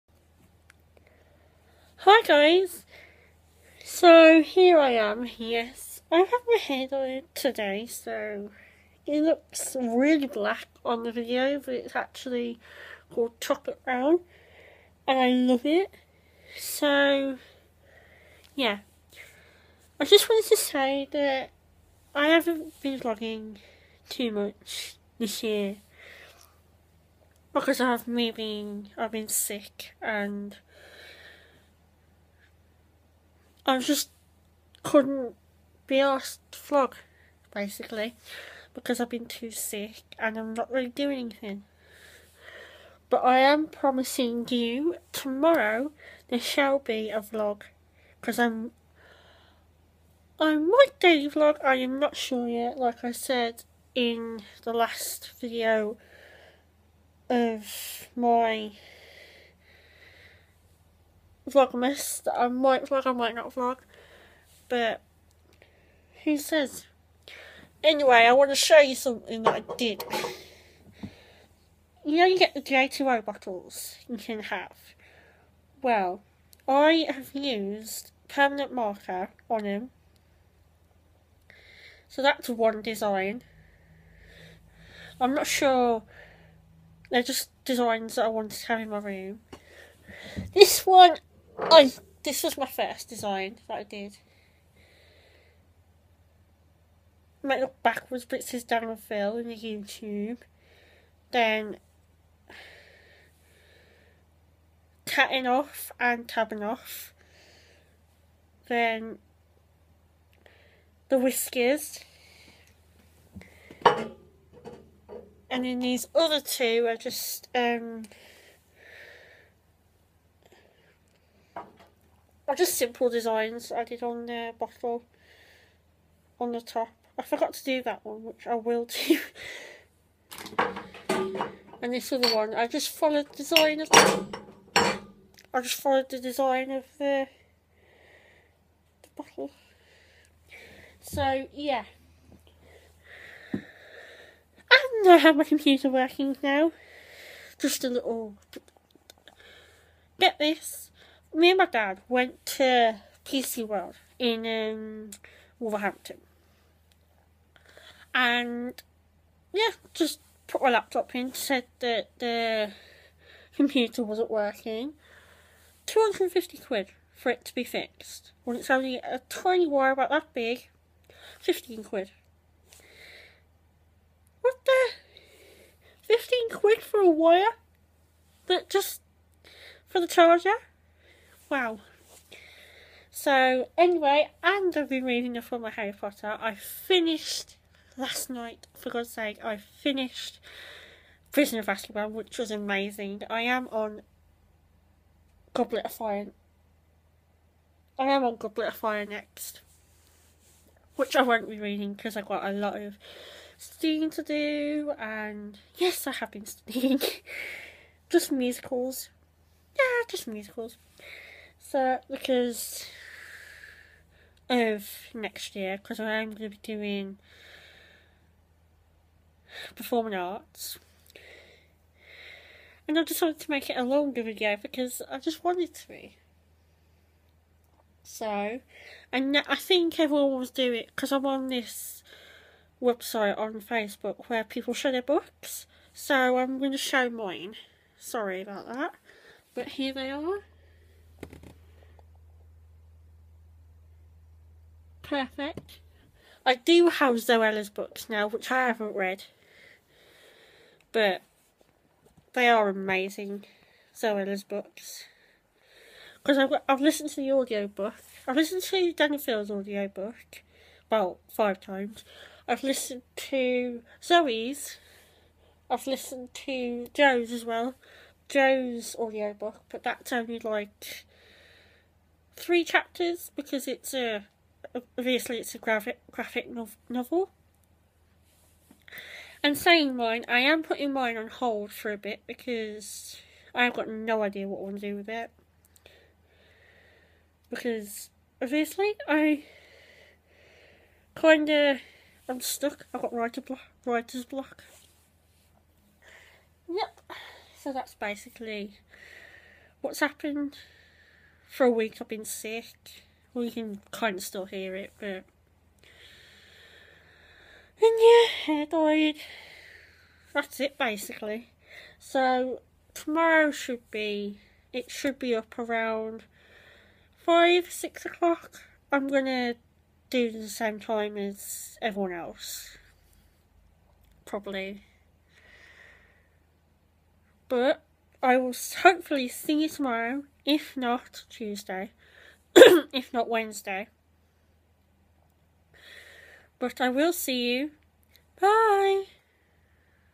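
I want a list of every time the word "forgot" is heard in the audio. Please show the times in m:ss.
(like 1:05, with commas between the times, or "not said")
2:07.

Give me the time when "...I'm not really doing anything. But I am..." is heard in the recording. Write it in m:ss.
0:40.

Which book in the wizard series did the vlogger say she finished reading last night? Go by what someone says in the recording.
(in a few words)
Prisoner of Azkaban.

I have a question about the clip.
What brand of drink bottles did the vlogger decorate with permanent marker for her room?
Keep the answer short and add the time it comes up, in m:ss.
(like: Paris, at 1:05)
J2O, at 1:12.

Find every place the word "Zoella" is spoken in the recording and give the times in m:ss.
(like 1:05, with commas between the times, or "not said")
4:07, 4:13.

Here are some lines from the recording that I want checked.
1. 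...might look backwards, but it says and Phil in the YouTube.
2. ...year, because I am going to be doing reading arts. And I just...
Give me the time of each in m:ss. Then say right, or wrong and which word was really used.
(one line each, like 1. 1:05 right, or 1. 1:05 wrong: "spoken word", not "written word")
1. 1:37 right
2. 3:35 wrong: "performing", not "reading".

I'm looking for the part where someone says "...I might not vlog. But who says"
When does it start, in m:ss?
1:03.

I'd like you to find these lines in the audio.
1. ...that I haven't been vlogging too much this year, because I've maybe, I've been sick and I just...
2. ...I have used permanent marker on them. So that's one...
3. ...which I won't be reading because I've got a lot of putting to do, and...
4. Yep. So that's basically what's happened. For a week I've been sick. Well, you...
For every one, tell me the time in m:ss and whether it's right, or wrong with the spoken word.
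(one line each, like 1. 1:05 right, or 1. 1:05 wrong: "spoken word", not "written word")
1. 0:21 right
2. 1:16 right
3. 3:20 wrong: "studying", not "putting"
4. 4:56 right.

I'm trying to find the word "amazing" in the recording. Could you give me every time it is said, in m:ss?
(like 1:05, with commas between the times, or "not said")
3:12, 4:12.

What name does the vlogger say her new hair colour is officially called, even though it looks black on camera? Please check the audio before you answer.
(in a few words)
chocolate brown.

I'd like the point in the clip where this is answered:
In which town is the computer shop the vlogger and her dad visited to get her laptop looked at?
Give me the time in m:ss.
2:35.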